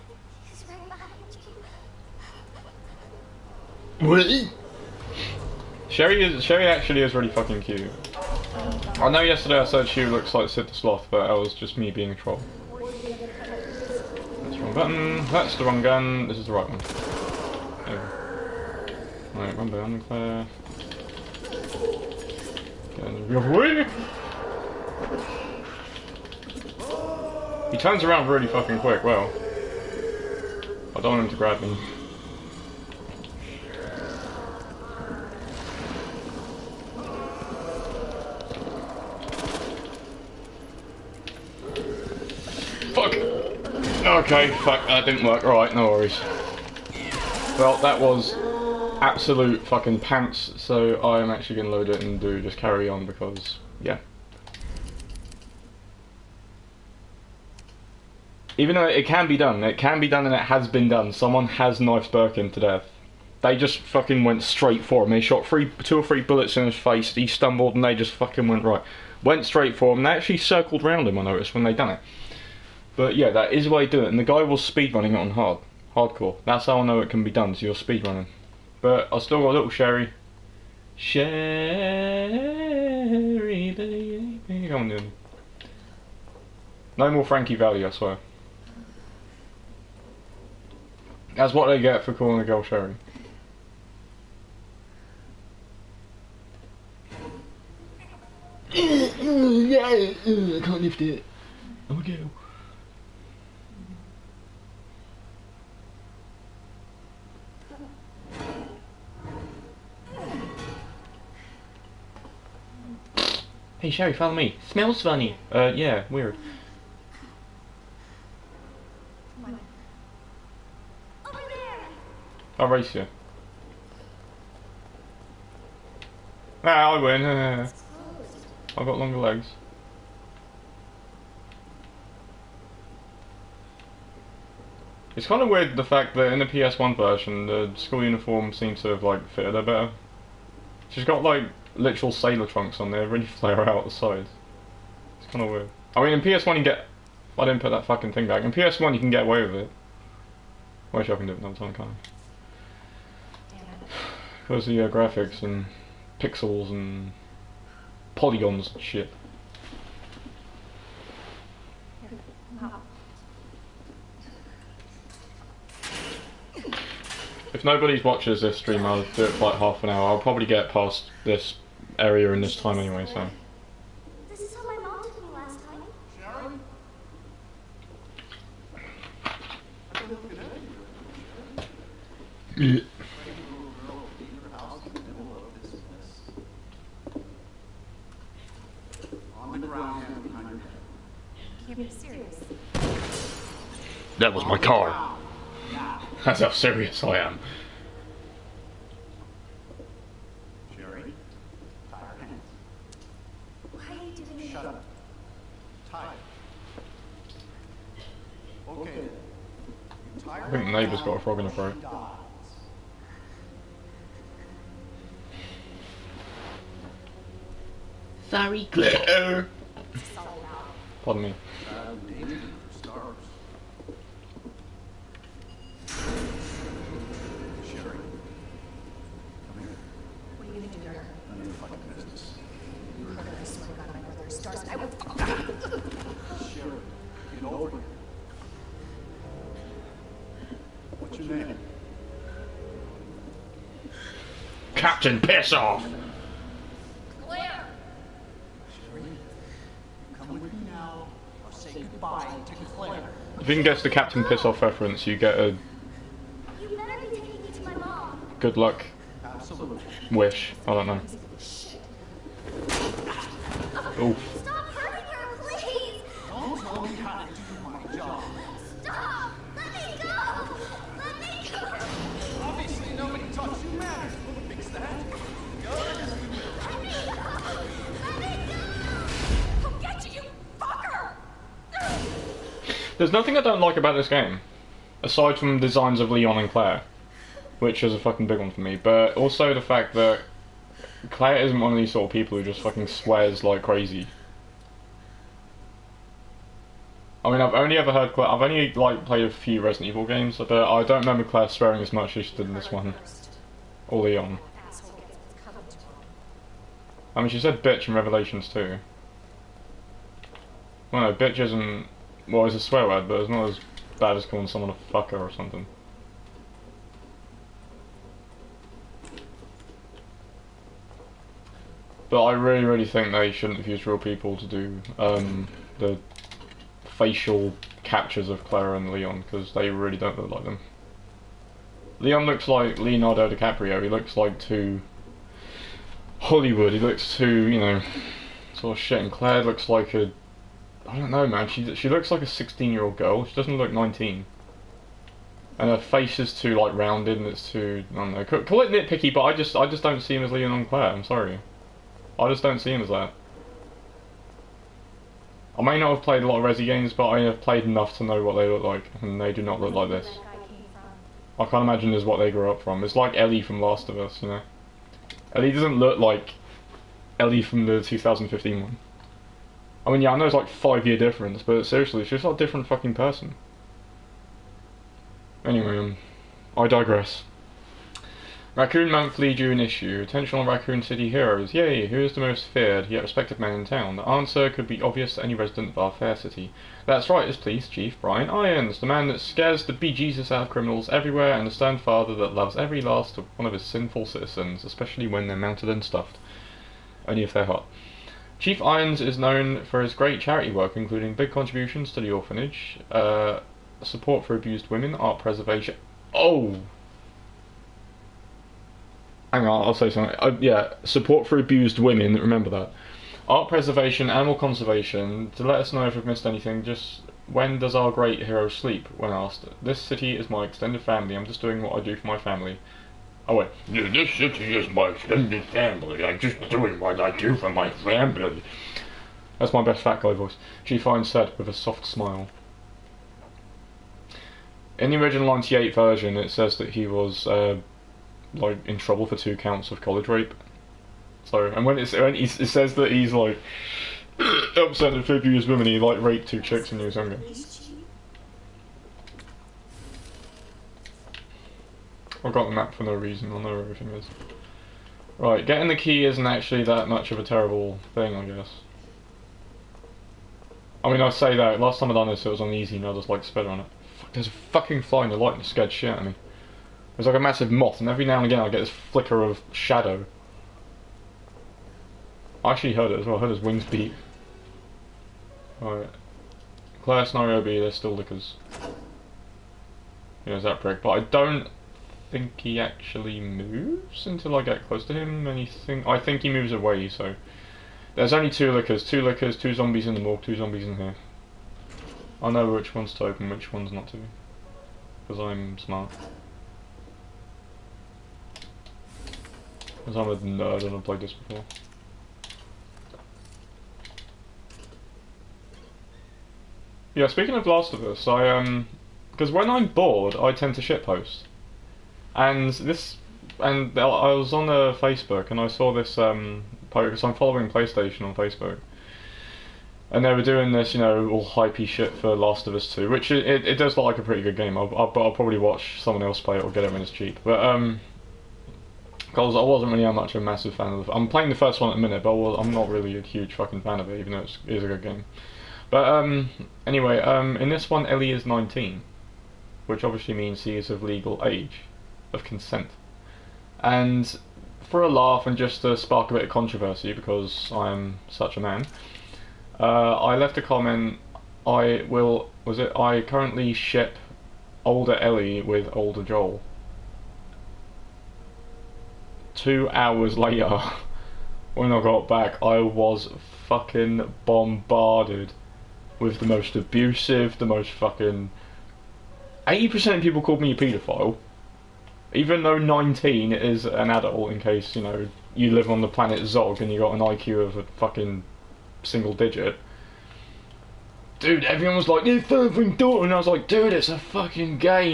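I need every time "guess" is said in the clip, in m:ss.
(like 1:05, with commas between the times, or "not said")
4:13, 7:38.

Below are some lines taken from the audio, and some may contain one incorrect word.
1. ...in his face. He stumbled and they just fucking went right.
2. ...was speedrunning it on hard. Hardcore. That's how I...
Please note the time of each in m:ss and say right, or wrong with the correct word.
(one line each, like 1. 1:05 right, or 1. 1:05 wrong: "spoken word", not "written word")
1. 1:06 right
2. 1:14 right.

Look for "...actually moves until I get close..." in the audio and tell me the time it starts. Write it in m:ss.
8:02.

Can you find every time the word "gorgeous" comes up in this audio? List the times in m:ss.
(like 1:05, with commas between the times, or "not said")
not said.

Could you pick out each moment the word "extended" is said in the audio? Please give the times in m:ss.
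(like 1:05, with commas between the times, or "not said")
7:00, 7:04.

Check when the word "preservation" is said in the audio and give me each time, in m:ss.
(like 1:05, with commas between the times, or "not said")
6:45, 6:53.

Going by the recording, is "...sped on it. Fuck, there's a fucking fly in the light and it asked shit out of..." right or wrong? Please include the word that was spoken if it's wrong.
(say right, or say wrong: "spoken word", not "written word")
wrong: "scared", not "asked".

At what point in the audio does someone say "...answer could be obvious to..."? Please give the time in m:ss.
6:24.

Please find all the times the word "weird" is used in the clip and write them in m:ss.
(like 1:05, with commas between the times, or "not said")
1:56, 2:15, 2:25.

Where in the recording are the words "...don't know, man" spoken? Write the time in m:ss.
5:40.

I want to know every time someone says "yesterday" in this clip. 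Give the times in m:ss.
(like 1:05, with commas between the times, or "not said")
0:09.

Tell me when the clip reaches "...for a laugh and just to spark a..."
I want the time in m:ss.
9:04.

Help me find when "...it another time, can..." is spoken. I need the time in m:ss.
2:31.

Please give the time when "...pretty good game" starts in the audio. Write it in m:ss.
8:44.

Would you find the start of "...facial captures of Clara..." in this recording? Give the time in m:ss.
5:26.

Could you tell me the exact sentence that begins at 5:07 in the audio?
I mean, she said bitch in Revelations too.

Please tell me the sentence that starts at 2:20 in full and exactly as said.
She's got like literal sailor trunks on there, really flare out the sides.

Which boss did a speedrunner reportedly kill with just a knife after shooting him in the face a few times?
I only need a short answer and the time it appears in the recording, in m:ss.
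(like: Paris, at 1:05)
Birkin, at 1:02.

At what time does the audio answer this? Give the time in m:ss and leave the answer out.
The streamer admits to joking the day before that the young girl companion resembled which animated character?
0:10.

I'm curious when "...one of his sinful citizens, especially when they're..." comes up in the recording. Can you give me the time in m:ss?
6:33.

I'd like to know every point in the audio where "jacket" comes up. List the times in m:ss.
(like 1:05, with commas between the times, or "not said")
not said.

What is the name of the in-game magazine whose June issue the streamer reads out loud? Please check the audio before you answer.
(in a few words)
Raccoon Monthly.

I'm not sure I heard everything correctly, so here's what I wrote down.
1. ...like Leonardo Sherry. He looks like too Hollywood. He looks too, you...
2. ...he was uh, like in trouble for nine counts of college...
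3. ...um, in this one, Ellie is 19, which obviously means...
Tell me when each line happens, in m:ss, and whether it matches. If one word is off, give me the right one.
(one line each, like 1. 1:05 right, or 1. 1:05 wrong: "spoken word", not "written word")
1. 5:32 wrong: "DiCaprio", not "Sherry"
2. 7:16 wrong: "two", not "nine"
3. 8:56 right.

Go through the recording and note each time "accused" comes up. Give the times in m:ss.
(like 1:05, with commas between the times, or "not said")
not said.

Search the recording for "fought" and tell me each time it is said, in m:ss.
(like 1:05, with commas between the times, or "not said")
not said.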